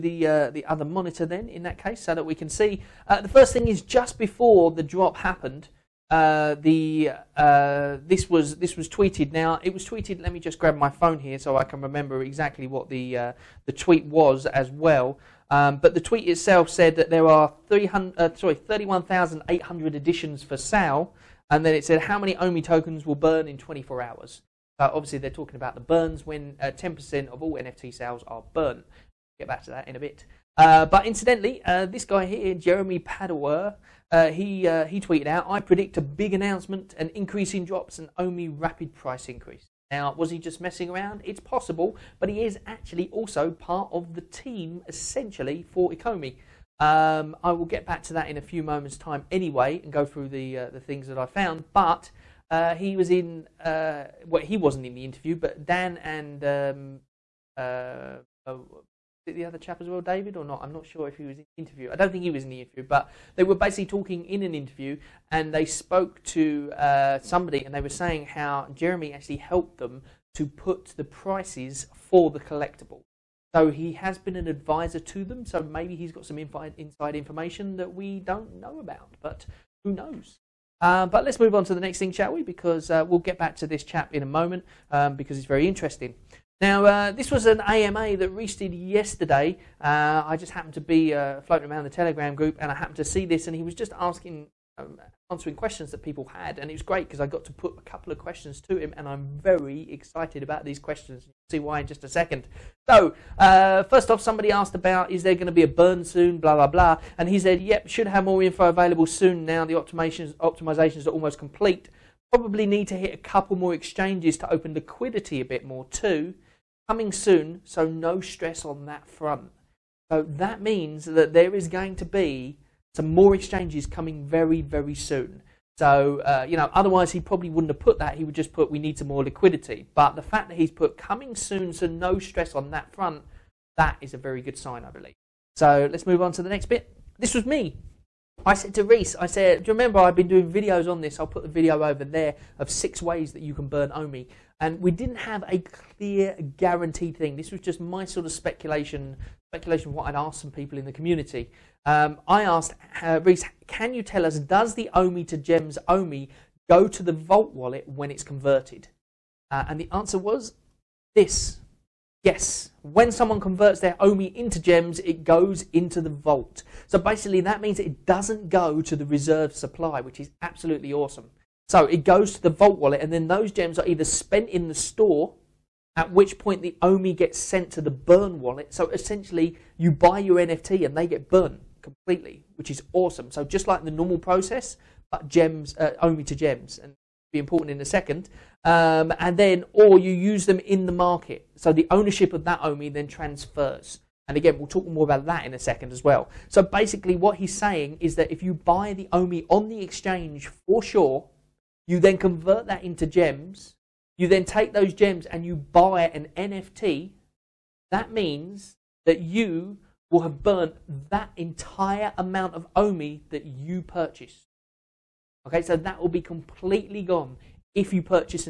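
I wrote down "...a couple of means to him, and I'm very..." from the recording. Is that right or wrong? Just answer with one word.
wrong.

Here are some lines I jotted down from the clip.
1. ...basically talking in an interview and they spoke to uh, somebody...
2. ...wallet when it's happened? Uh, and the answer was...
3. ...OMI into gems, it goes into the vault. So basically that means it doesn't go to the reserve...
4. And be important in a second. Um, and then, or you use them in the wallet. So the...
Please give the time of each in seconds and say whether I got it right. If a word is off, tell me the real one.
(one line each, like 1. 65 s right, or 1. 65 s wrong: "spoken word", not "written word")
1. 63 s right
2. 157 s wrong: "converted", not "happened"
3. 163 s right
4. 186 s wrong: "market", not "wallet".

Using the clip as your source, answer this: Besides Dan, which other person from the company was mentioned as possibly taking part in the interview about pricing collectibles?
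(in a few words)
David.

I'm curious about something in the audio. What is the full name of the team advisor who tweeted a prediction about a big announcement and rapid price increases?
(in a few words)
Jeremy Padawer.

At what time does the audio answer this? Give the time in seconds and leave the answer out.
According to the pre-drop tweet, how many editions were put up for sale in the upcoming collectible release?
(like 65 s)
18 s.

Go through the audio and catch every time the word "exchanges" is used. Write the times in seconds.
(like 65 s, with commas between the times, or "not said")
113 s, 123 s, 199 s.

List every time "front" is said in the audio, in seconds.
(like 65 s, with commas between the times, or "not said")
119 s, 132 s.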